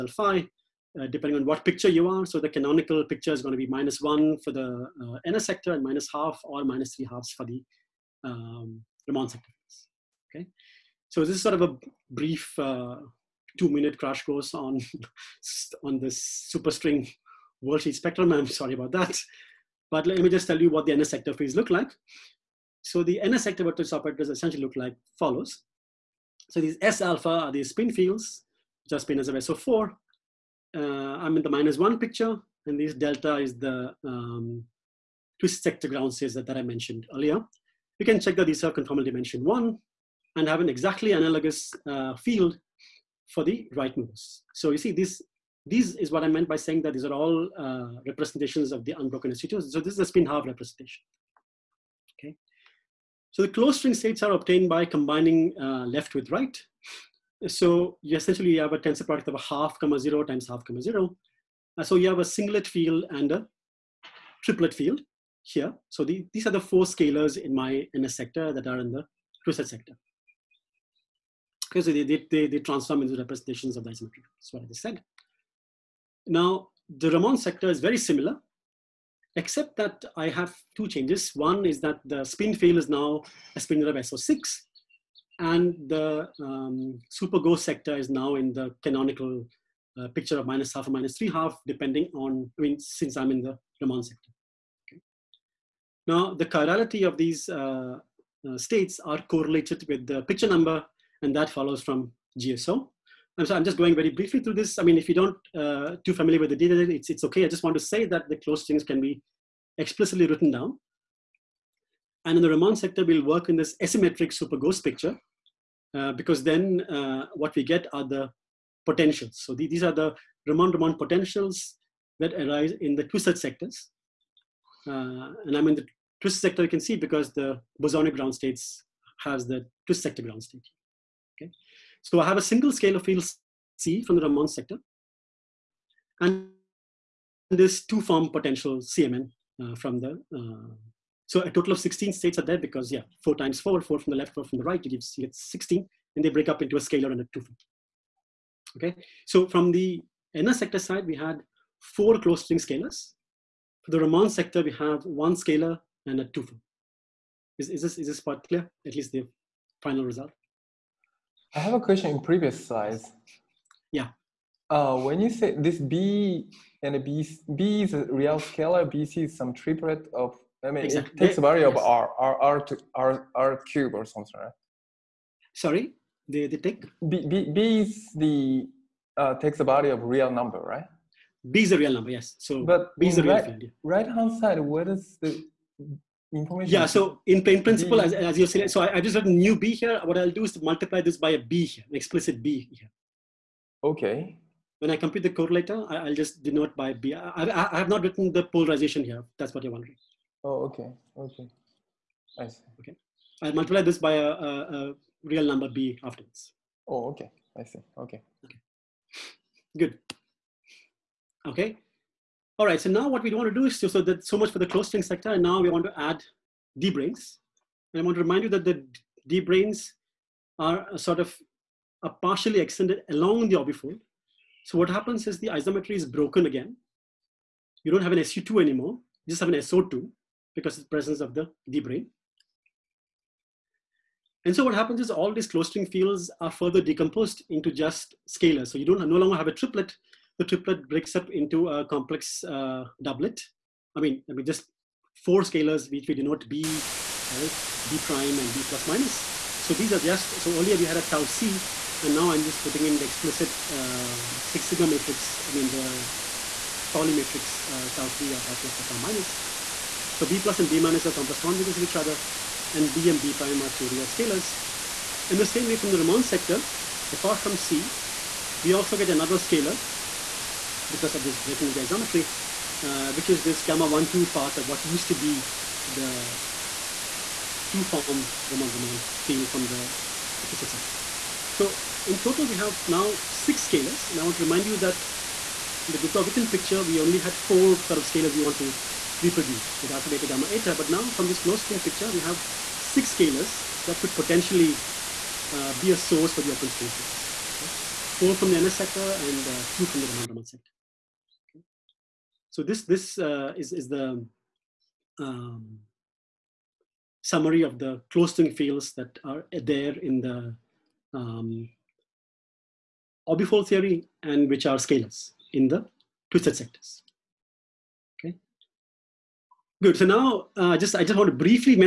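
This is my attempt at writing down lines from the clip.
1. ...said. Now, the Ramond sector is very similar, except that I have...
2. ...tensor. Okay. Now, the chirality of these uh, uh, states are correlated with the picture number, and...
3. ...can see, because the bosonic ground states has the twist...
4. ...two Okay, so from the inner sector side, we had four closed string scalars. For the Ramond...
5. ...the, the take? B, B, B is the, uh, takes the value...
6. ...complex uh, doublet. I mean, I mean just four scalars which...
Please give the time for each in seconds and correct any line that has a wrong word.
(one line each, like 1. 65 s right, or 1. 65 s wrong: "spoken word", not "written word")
1. 74 s right
2. 94 s wrong: "sector", not "tensor"
3. 126 s right
4. 147 s right
5. 176 s right
6. 241 s right.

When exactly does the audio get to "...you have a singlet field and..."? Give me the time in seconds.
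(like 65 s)
61 s.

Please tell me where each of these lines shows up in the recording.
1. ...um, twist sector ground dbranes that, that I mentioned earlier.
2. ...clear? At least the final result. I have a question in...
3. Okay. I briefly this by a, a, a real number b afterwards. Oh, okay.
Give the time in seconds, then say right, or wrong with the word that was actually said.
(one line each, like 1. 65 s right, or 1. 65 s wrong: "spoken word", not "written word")
1. 34 s wrong: "states", not "dbranes"
2. 158 s right
3. 202 s wrong: "multiply", not "briefly".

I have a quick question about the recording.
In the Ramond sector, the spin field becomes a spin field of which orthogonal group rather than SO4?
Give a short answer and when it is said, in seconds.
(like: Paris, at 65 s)
SO6, at 83 s.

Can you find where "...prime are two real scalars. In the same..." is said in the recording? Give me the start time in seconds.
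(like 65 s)
263 s.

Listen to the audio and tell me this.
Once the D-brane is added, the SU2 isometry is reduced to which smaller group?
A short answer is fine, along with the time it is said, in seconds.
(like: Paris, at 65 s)
SO2, at 229 s.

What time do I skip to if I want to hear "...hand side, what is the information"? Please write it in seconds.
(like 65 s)
184 s.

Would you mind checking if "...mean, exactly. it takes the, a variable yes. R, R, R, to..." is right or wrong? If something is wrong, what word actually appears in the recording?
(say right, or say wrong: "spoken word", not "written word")
right.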